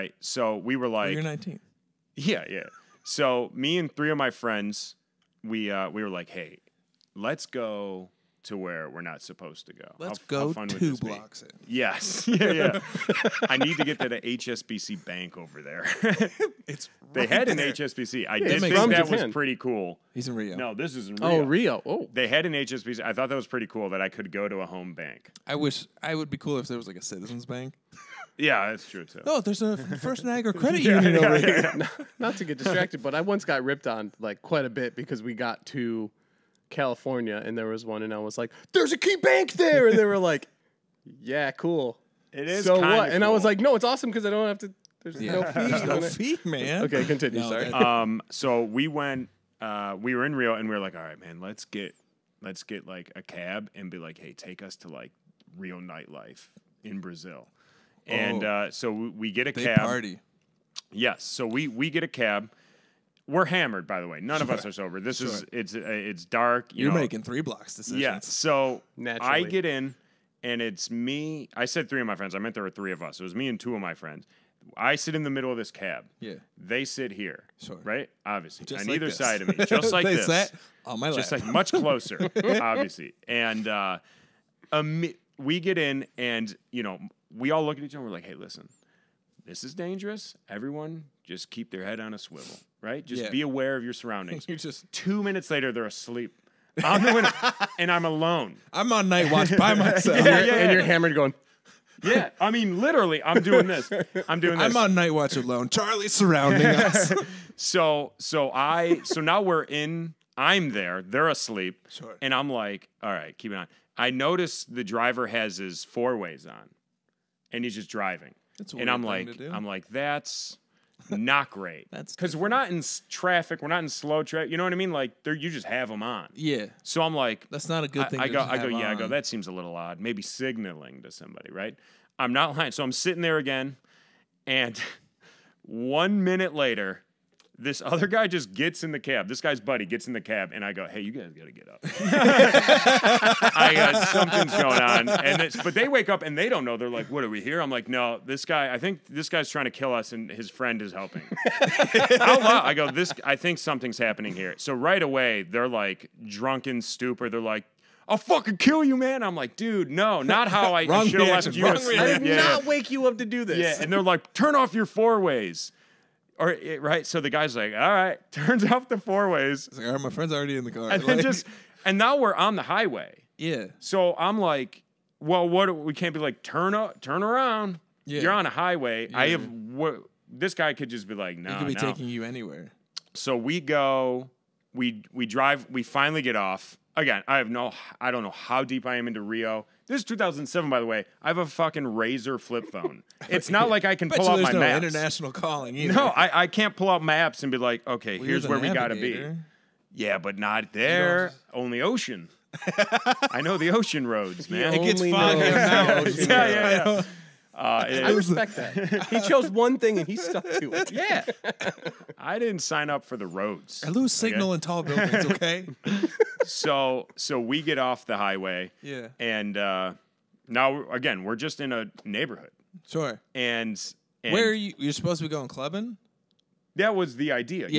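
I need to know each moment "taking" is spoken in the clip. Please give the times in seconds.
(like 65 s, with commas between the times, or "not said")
181 s.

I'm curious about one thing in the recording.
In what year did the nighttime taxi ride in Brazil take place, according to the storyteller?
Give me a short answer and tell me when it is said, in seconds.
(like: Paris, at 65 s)
2007, at 190 s.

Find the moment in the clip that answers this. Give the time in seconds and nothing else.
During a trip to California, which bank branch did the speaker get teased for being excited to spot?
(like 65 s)
38 s.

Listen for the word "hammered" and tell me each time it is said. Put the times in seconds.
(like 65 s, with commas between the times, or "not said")
63 s, 100 s.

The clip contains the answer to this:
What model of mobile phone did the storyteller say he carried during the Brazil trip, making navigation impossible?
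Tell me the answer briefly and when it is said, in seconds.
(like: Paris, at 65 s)
Razr flip phone, at 191 s.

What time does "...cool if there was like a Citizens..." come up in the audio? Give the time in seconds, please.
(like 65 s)
26 s.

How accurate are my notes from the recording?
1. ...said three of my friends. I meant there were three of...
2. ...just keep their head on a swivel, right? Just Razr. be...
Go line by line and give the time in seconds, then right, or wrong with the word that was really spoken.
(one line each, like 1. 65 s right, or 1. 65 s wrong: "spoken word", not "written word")
1. 71 s right
2. 91 s wrong: "Yeah", not "Razr".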